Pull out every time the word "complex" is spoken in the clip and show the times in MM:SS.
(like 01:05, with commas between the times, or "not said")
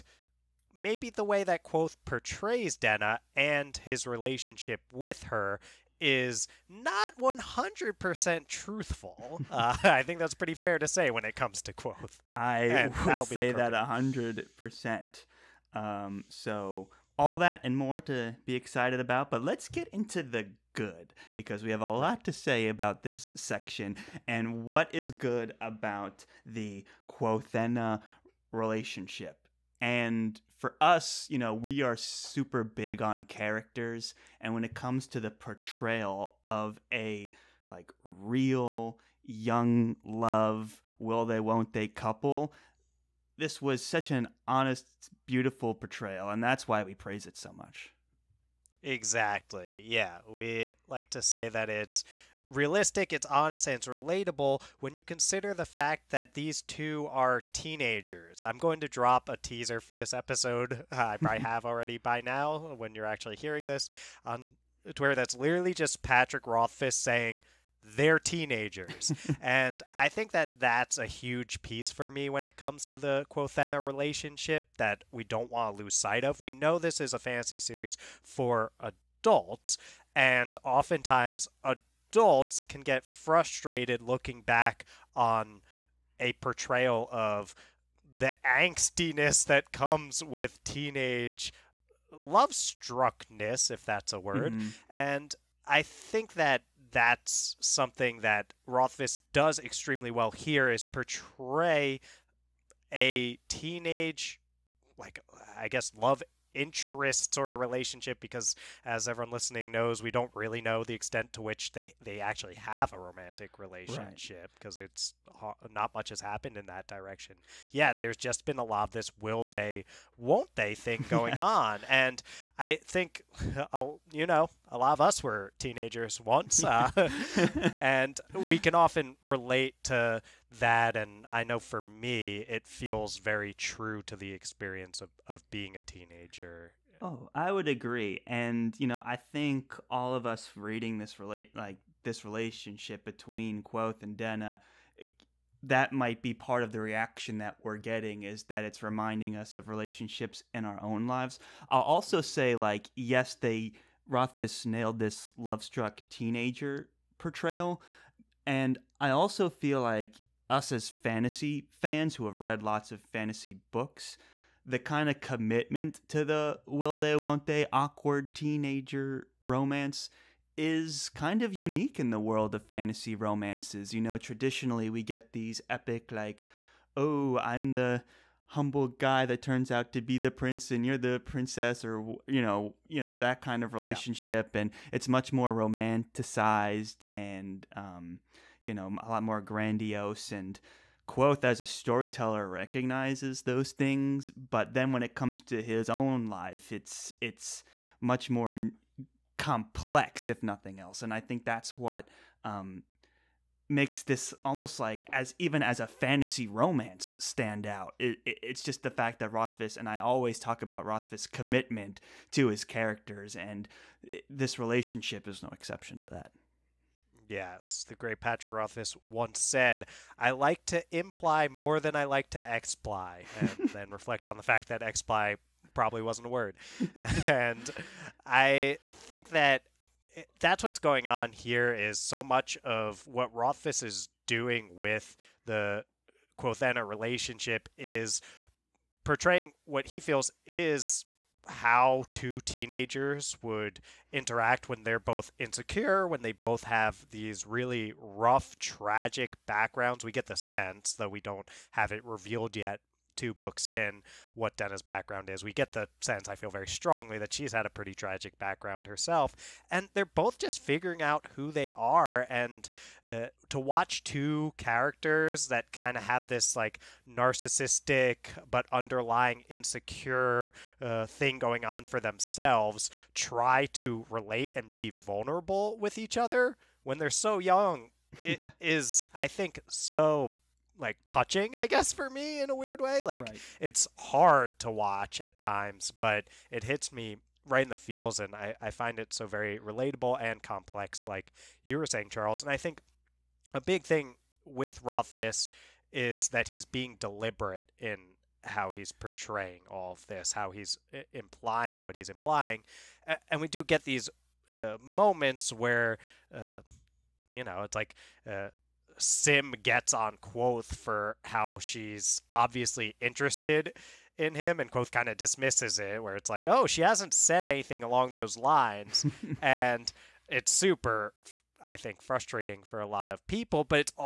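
03:19, 04:50.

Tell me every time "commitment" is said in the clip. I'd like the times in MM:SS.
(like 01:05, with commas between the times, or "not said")
02:45, 03:31.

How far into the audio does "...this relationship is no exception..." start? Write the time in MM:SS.
03:34.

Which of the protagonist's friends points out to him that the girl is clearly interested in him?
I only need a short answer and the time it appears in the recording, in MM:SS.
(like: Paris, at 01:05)
Sim, at 05:08.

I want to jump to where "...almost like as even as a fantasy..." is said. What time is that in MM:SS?
03:24.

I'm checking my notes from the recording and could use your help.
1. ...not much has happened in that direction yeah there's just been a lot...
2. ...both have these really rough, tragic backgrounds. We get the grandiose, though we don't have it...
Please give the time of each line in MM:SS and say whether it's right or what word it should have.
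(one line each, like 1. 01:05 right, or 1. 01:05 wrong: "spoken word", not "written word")
1. 01:55 right
2. 04:06 wrong: "sense", not "grandiose".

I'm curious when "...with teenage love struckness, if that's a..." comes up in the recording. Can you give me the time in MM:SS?
01:30.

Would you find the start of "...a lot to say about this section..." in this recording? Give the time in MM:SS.
00:21.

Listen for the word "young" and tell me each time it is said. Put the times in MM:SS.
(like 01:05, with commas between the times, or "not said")
00:39, 04:37.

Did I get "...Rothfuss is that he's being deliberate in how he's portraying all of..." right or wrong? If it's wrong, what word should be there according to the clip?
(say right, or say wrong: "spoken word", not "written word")
right.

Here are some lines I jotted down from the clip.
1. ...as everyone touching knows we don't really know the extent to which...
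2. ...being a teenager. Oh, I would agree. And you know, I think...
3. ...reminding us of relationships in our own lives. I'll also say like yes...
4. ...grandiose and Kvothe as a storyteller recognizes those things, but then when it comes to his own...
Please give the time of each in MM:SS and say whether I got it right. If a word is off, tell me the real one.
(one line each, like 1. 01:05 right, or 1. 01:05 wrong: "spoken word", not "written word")
1. 01:48 wrong: "listening", not "touching"
2. 02:15 right
3. 02:28 right
4. 03:09 right.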